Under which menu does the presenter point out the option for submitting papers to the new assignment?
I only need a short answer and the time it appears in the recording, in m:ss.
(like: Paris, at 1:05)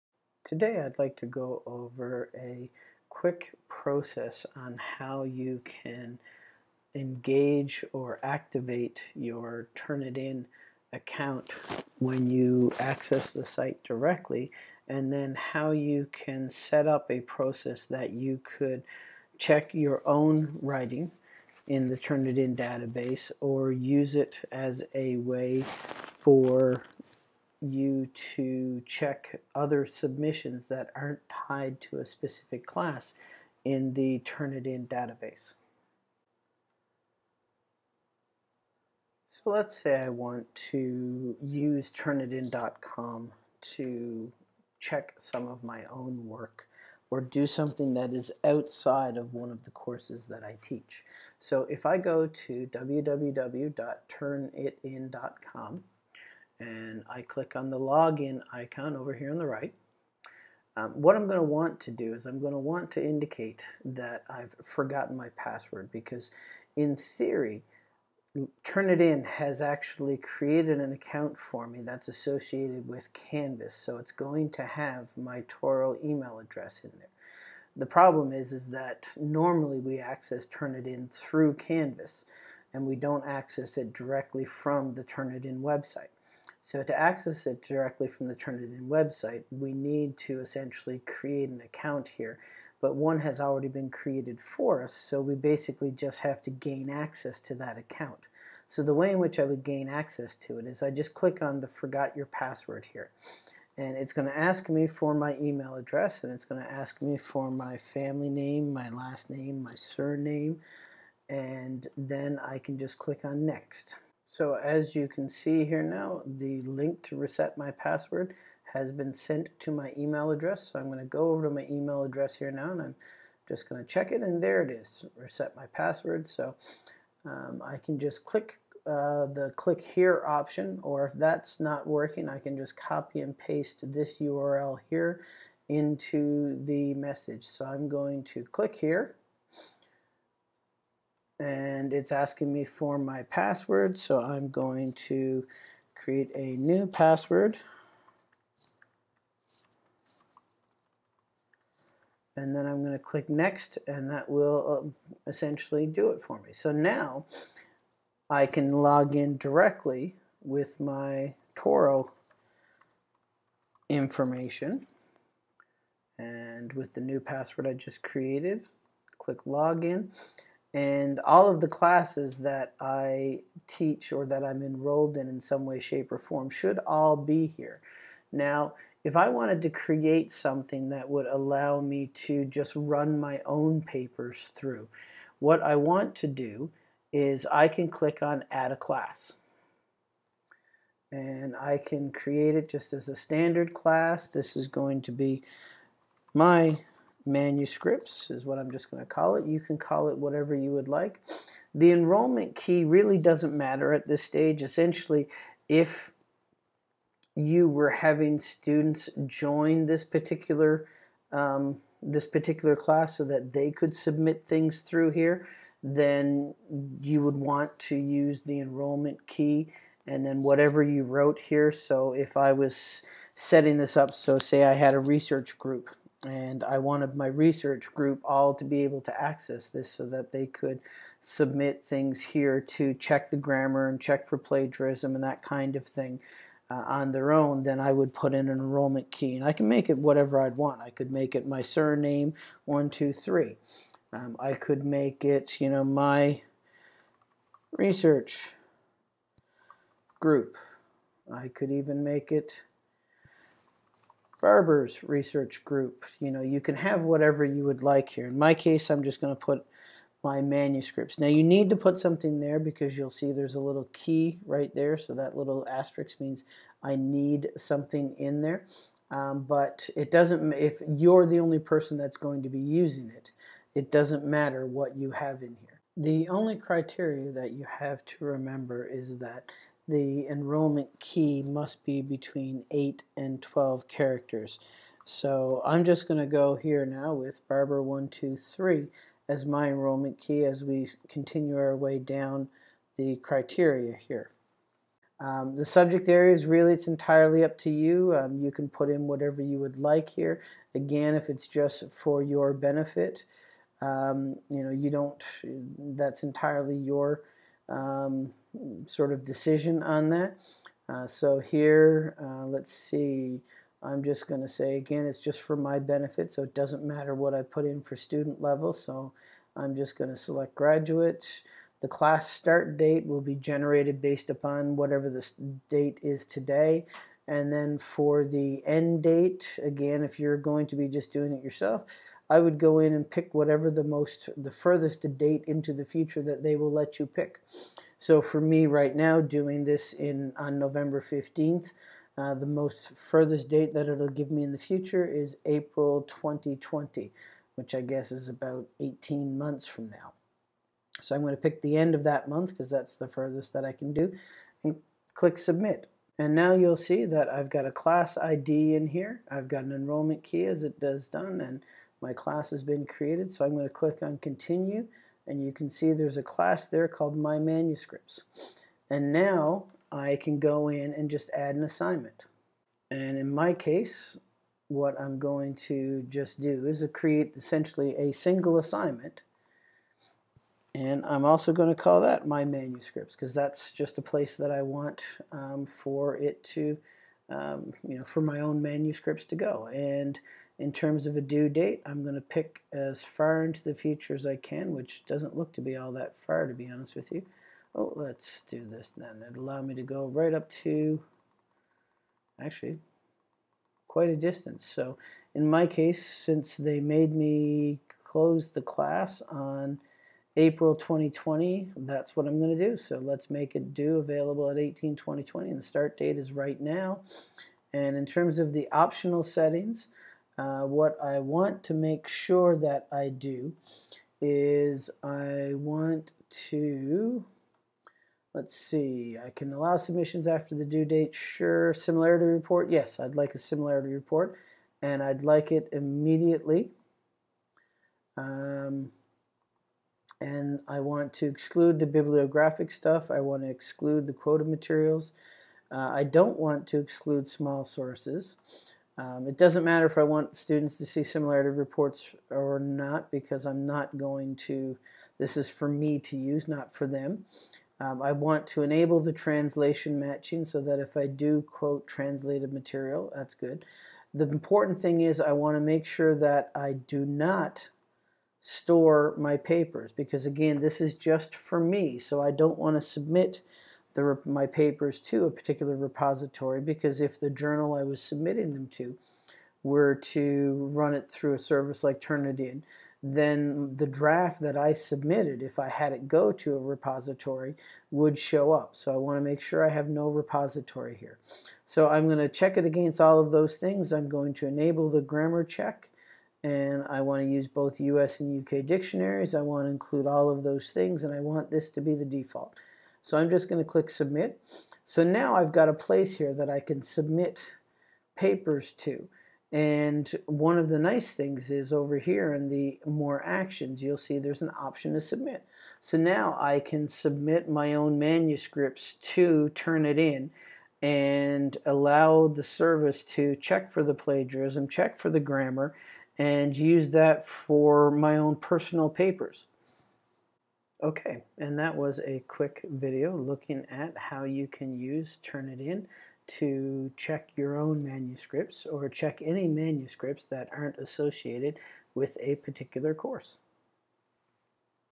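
More actions, at 8:32.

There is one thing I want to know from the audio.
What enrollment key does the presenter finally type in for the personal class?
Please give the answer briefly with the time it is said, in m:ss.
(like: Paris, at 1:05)
Barber123, at 4:47.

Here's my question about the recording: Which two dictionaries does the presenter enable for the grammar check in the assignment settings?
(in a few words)
US and UK.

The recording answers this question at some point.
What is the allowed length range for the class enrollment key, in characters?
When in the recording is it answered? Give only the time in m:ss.
4:42.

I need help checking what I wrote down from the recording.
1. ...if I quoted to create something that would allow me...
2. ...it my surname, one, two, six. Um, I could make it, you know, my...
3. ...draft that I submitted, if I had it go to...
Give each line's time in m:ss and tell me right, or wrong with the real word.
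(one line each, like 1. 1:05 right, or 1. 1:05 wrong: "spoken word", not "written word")
1. 2:59 wrong: "wanted", not "quoted"
2. 4:01 wrong: "three", not "six"
3. 8:03 right.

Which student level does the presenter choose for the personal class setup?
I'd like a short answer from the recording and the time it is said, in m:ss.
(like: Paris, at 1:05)
Graduates, at 5:20.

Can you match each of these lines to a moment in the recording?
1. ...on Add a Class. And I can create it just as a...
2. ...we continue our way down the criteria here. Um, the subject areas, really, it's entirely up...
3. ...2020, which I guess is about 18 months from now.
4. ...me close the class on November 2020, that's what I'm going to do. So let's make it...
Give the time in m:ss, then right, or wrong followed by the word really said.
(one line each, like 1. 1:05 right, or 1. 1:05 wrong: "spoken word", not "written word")
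1. 3:08 right
2. 4:50 right
3. 5:46 right
4. 6:47 wrong: "April", not "November".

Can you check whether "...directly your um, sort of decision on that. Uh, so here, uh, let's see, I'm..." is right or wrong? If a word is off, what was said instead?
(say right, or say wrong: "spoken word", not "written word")
wrong: "entirely", not "directly".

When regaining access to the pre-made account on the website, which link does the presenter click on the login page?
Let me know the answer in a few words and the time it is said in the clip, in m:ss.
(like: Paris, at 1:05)
Forgot your password, at 1:41.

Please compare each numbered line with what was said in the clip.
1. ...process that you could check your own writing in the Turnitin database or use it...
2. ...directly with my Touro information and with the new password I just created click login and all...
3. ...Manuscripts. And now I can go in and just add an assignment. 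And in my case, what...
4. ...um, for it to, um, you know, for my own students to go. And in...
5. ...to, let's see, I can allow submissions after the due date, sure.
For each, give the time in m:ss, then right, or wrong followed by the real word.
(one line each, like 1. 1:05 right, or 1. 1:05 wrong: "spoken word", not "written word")
1. 0:17 right
2. 2:39 right
3. 6:07 right
4. 6:25 wrong: "manuscripts", not "students"
5. 7:06 right.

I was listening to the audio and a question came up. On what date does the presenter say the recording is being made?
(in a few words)
November 15th.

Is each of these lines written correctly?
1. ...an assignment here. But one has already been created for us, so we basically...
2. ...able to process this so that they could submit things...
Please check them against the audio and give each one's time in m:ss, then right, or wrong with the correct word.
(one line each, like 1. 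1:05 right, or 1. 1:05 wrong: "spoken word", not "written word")
1. 1:31 wrong: "account", not "assignment"
2. 3:48 wrong: "access", not "process".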